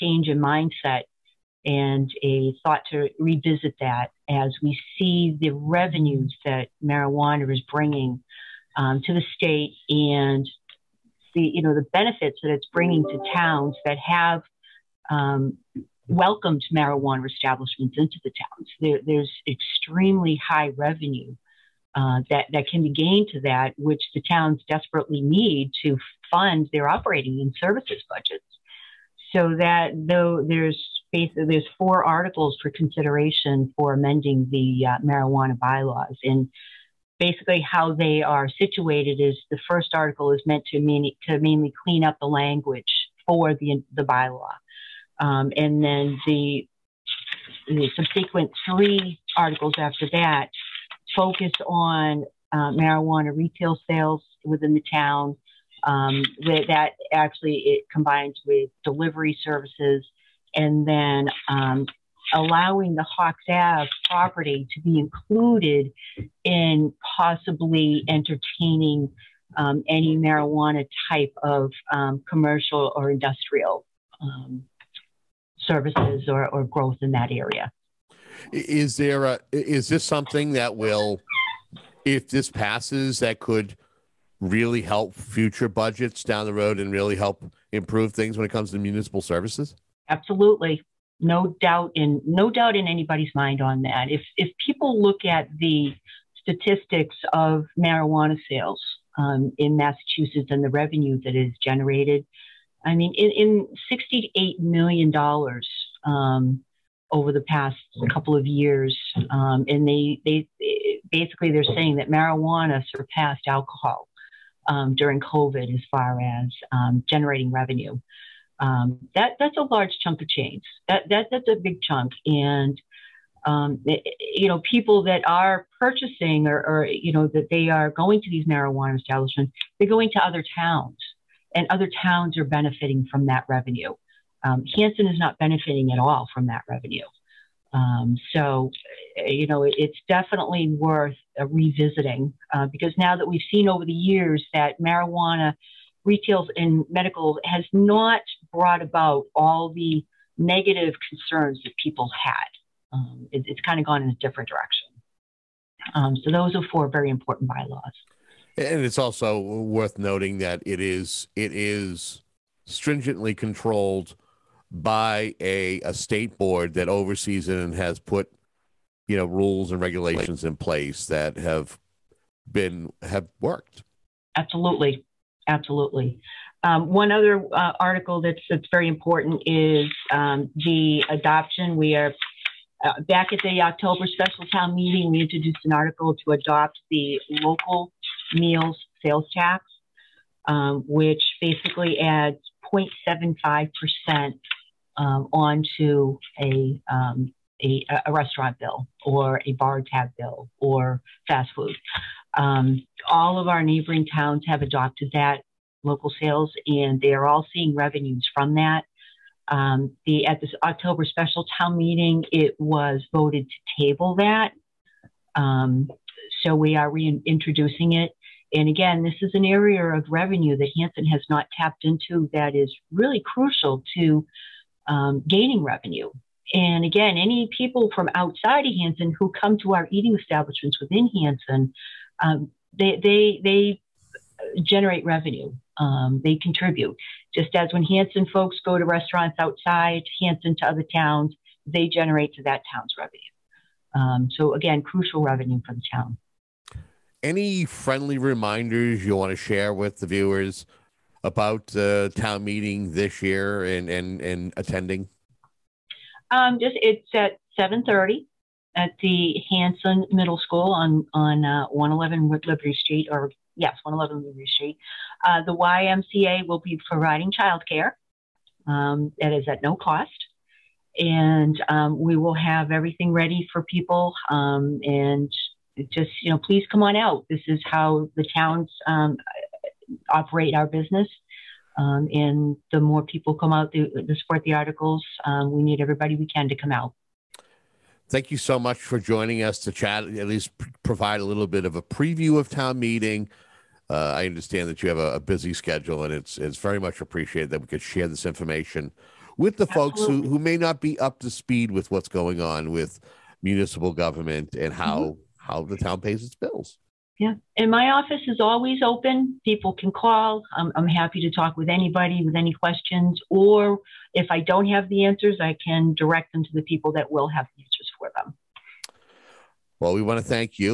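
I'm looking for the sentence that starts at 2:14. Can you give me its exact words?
Um, Hanson is not benefiting at all from that revenue.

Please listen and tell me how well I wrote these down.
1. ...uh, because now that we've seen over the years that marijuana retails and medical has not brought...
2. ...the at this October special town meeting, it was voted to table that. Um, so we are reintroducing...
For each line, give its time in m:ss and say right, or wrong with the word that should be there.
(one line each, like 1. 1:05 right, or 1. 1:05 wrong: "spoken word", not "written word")
1. 2:22 right
2. 3:30 right.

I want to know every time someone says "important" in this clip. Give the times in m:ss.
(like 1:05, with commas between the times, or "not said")
2:37, 2:58.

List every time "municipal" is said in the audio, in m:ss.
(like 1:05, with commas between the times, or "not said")
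1:28, 5:03.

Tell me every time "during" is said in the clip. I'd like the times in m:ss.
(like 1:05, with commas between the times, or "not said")
1:54.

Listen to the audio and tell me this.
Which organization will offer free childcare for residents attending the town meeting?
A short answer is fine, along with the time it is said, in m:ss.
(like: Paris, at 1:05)
YMCA, at 4:25.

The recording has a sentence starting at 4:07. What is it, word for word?
Any friendly reminders you want to share with the viewers about the uh, town meeting this year and and and attending?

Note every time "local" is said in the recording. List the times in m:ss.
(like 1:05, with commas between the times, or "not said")
3:07, 3:25.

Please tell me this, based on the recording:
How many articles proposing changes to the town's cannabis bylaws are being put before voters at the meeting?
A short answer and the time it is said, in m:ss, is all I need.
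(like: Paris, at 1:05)
4, at 0:31.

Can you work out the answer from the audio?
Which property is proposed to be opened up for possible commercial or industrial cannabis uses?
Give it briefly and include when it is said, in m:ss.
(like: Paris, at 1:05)
Hawks Ave, at 1:03.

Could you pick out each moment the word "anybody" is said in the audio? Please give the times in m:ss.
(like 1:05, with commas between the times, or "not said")
1:32, 5:11.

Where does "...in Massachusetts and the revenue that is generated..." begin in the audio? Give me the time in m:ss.
1:39.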